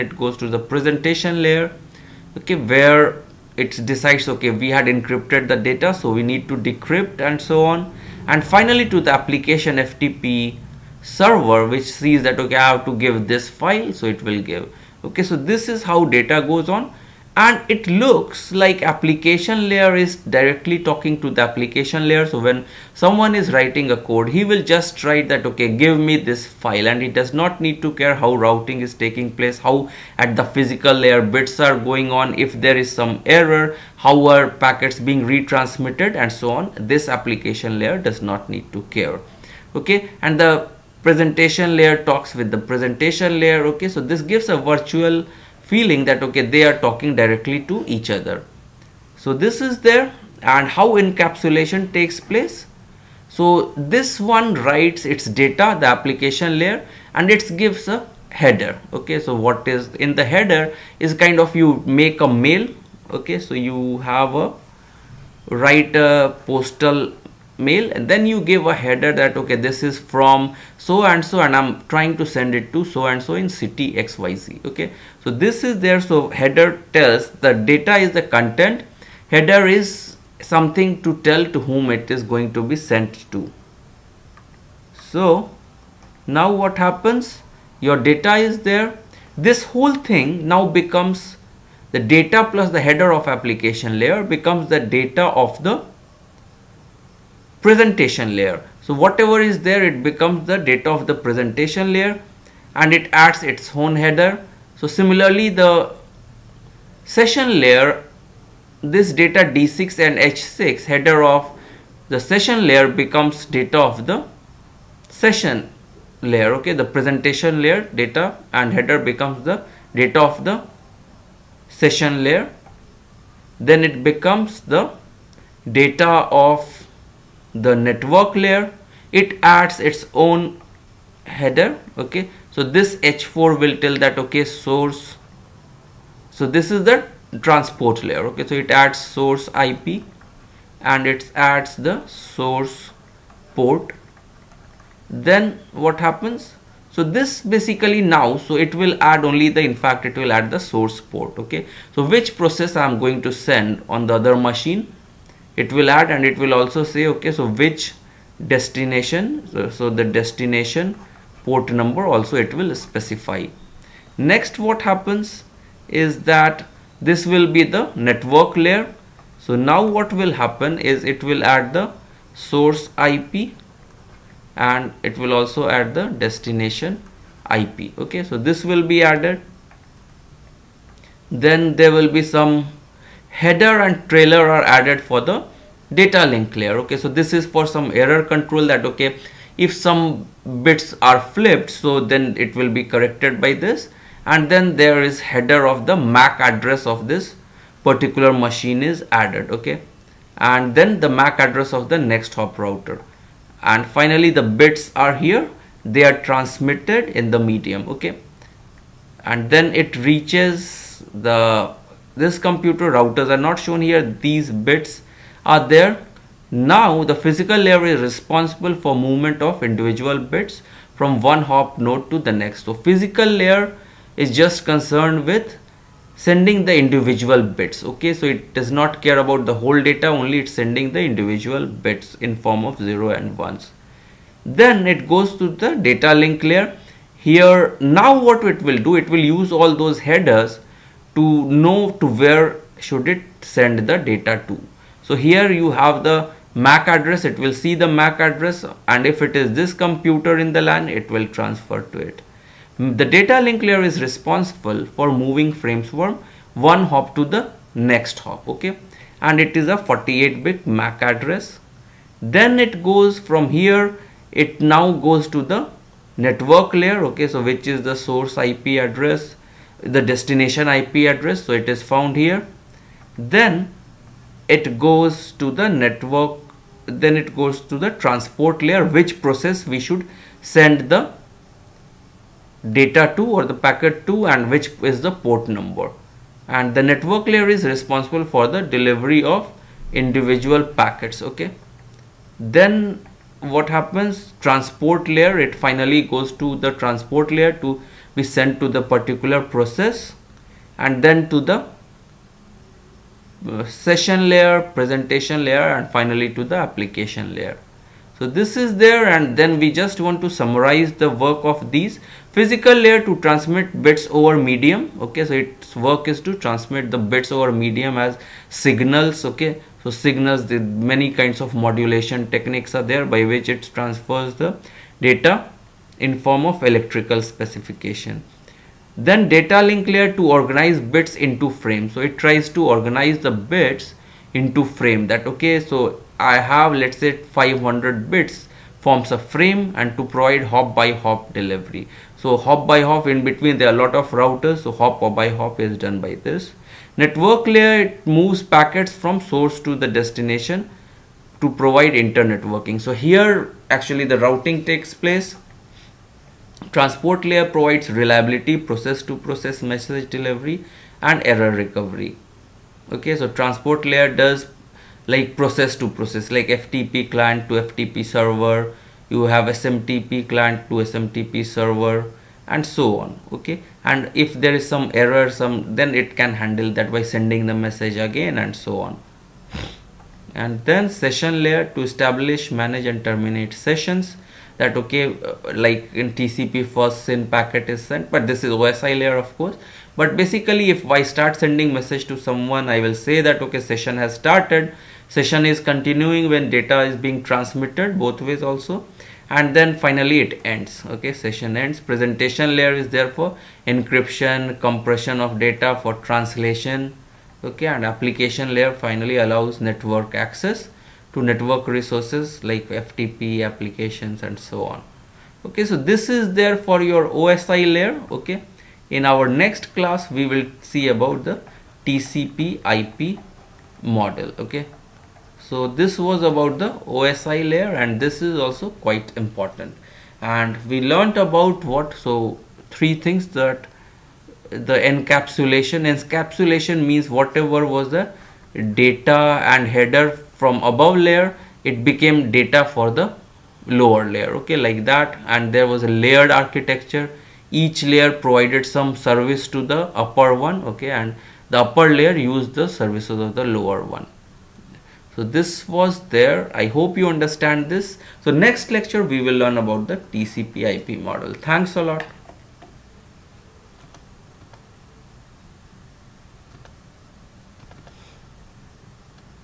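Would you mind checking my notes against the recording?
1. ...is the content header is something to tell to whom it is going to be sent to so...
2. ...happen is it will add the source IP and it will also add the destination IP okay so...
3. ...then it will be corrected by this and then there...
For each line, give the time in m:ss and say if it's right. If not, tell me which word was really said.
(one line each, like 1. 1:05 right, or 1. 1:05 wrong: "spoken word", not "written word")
1. 1:17 right
2. 2:50 right
3. 3:12 right.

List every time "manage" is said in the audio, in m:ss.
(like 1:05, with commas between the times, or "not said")
6:22.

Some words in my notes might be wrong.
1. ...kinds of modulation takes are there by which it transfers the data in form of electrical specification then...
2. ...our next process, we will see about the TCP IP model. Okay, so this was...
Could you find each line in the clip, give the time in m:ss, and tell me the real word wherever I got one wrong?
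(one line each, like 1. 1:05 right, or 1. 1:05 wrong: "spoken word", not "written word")
1. 5:21 wrong: "techniques", not "takes"
2. 6:59 wrong: "class", not "process".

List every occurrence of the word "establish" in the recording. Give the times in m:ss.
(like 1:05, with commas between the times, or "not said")
6:21.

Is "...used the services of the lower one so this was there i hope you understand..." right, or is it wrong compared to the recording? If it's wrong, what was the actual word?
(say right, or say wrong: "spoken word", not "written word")
right.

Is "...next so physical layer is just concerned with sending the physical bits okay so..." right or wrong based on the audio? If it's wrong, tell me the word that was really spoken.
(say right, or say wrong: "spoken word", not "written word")
wrong: "individual", not "physical".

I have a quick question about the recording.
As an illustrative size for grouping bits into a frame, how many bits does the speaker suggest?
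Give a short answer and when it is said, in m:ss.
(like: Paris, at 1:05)
500, at 5:37.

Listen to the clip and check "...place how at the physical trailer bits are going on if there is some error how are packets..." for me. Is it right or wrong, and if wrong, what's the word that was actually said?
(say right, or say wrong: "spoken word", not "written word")
wrong: "layer", not "trailer".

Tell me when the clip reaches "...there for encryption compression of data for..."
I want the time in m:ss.
6:42.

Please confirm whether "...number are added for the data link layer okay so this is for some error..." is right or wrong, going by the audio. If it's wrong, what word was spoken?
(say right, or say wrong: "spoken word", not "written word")
wrong: "trailer", not "number".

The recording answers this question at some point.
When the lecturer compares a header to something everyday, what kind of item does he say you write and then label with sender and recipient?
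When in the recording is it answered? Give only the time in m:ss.
1:06.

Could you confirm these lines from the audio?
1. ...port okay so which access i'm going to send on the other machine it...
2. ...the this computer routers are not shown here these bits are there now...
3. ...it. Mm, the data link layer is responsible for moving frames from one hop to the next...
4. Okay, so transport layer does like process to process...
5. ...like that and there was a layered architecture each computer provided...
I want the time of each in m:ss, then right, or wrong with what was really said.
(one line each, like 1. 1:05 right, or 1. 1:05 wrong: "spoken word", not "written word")
1. 2:31 wrong: "process", not "access"
2. 3:31 right
3. 4:11 right
4. 6:02 right
5. 7:24 wrong: "layer", not "computer".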